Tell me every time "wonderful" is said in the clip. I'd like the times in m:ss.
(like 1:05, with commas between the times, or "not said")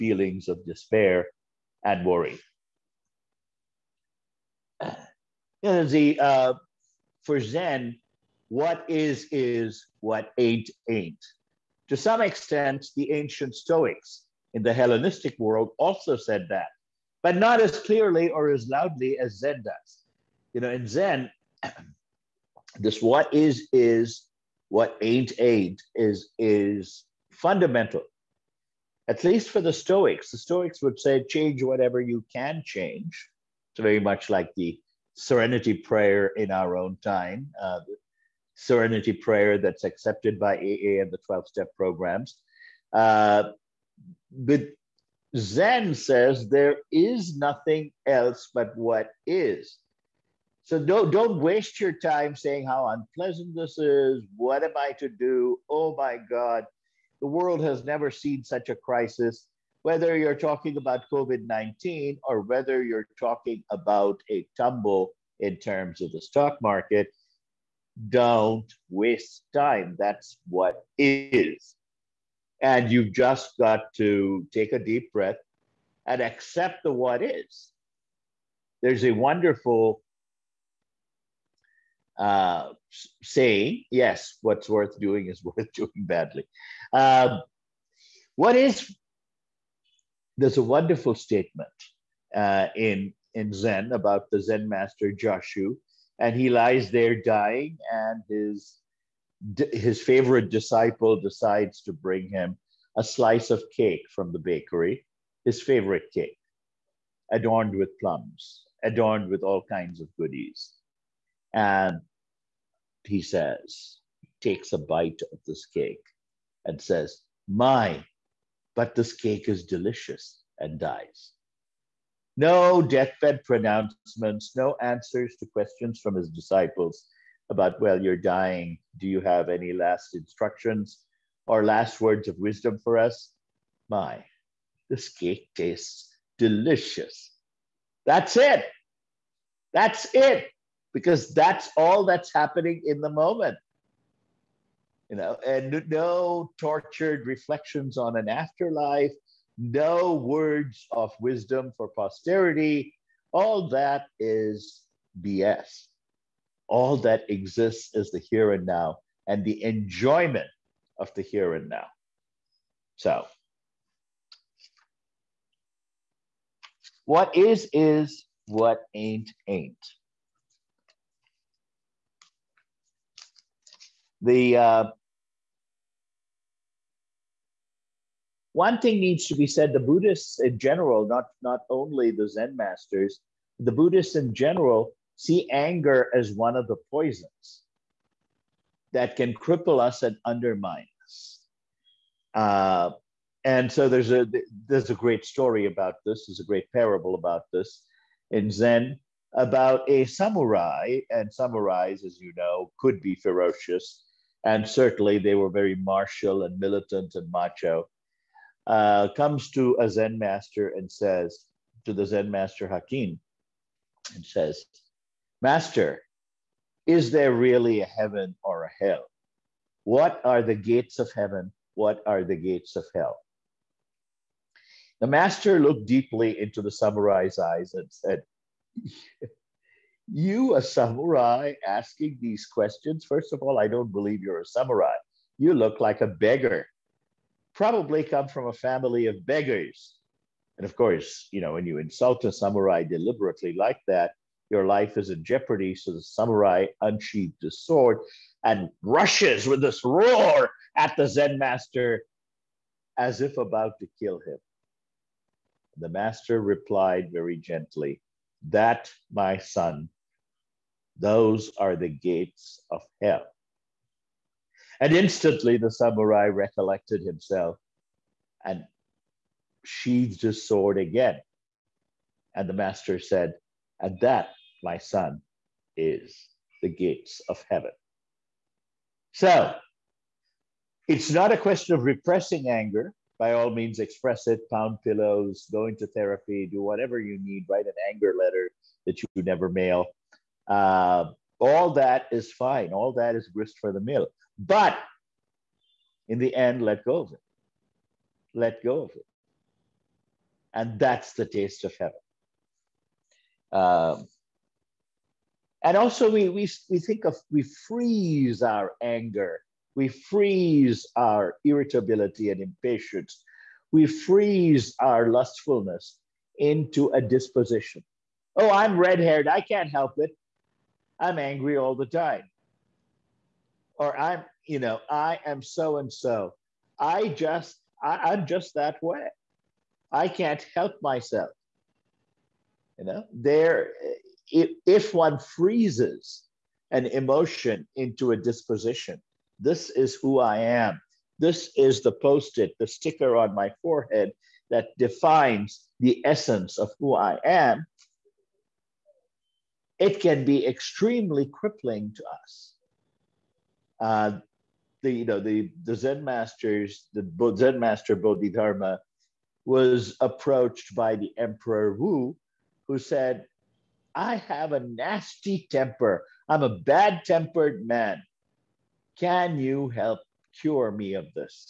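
1:19, 1:30.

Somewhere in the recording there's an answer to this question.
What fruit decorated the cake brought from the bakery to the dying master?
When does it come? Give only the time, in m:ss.
1:47.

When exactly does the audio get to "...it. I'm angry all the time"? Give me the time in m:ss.
5:19.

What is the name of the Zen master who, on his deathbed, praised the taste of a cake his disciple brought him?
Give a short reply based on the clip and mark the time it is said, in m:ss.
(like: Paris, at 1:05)
Joshu, at 1:35.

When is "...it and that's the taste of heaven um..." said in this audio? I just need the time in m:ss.
4:58.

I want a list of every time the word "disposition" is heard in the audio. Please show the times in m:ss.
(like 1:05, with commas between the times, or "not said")
5:17, 5:38.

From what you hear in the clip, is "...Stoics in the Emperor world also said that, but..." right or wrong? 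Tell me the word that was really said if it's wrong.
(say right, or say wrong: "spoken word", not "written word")
wrong: "Hellenistic", not "Emperor".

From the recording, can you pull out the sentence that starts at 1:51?
And he says, takes a bite of this cake and says, My, but this cake is delicious, and dies.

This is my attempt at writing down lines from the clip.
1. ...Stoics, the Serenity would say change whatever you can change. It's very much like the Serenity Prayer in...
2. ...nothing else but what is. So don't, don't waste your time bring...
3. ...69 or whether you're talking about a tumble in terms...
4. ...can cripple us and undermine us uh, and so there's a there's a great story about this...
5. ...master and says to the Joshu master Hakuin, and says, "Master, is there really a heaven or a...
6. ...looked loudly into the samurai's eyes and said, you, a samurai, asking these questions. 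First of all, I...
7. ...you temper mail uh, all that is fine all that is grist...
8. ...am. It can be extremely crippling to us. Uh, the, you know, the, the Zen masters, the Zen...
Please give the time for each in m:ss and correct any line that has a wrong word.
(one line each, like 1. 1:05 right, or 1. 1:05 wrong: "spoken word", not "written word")
1. 0:29 wrong: "Stoics", not "Serenity"
2. 0:47 wrong: "saying", not "bring"
3. 1:01 wrong: "19", not "69"
4. 3:09 right
5. 3:30 wrong: "Zen", not "Joshu"
6. 3:45 wrong: "deeply", not "loudly"
7. 4:49 wrong: "never", not "temper"
8. 5:47 right.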